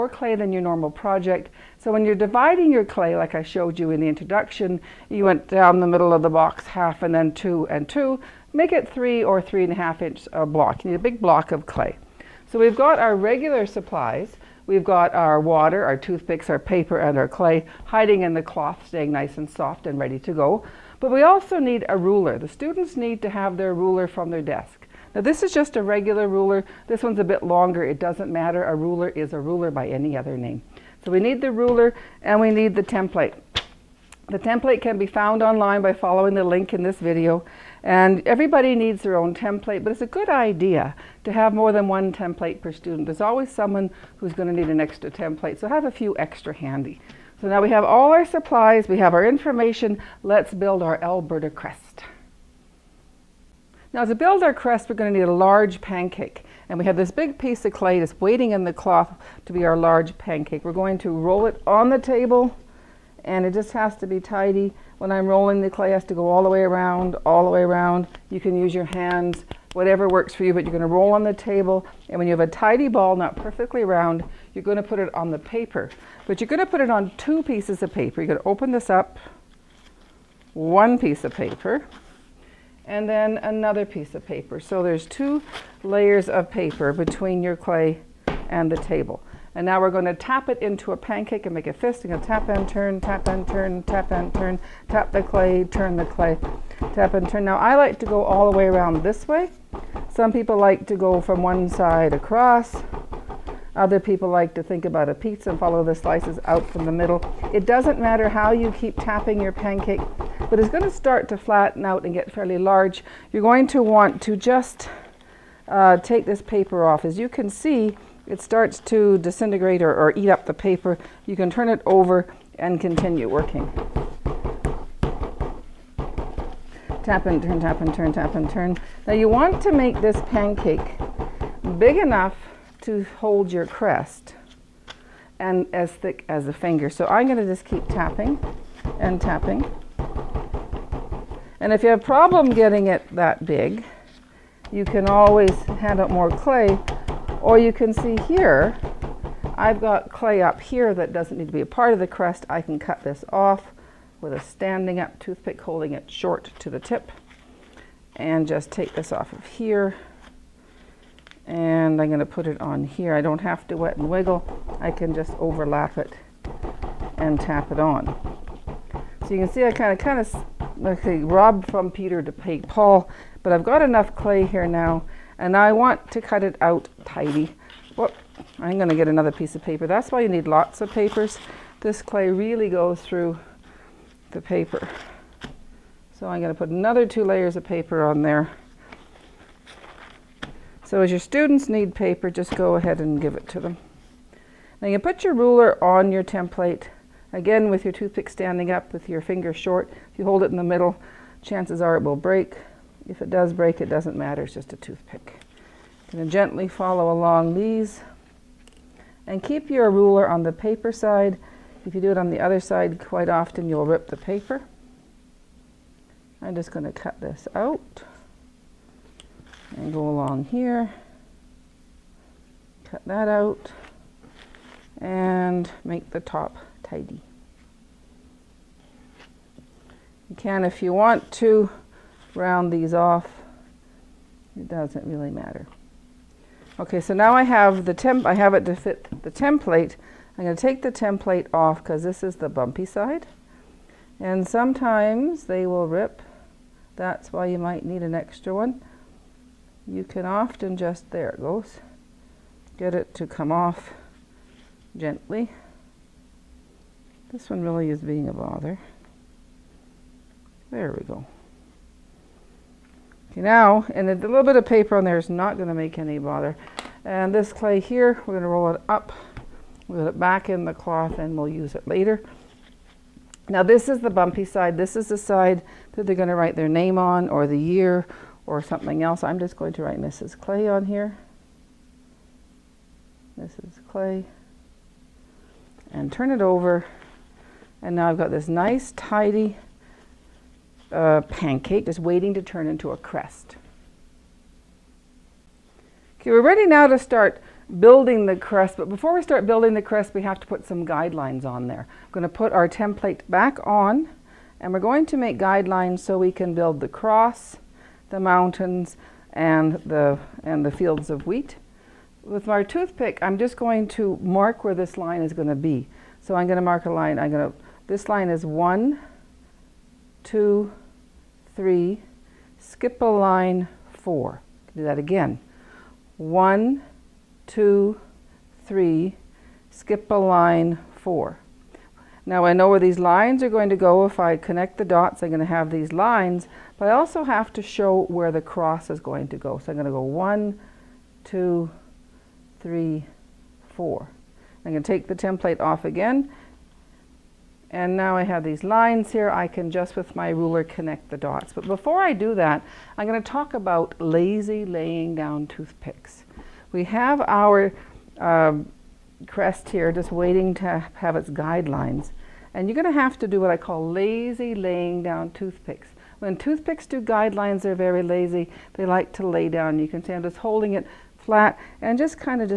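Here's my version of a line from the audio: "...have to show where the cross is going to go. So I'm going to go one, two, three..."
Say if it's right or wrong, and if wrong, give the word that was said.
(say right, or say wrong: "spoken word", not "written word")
right.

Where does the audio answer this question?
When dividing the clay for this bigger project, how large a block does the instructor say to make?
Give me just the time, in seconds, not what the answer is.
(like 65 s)
8 s.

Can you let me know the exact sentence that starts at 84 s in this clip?
So there's two layers of paper between your clay and the table.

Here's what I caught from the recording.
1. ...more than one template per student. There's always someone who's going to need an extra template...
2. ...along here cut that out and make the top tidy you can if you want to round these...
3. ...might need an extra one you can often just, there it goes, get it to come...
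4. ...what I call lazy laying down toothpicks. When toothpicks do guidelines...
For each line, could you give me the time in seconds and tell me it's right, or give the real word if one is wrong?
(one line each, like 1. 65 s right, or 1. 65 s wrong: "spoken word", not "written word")
1. 41 s right
2. 220 s right
3. 247 s right
4. 363 s right.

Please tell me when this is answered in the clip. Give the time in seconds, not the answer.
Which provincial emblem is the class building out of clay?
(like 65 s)
51 s.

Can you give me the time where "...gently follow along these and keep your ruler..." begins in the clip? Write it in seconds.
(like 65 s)
206 s.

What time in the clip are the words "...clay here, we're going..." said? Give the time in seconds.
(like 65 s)
267 s.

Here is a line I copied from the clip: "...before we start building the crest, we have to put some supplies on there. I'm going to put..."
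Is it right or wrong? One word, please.
wrong.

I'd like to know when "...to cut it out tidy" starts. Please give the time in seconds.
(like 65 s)
176 s.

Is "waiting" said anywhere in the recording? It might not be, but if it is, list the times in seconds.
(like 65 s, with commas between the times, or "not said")
58 s, 291 s, 360 s.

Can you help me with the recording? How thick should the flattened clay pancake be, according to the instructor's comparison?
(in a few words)
As thick as a finger.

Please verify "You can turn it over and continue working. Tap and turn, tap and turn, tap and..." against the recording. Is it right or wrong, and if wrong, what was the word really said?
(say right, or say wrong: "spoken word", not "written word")
right.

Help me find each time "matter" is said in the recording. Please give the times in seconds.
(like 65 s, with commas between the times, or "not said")
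28 s, 107 s, 204 s, 235 s.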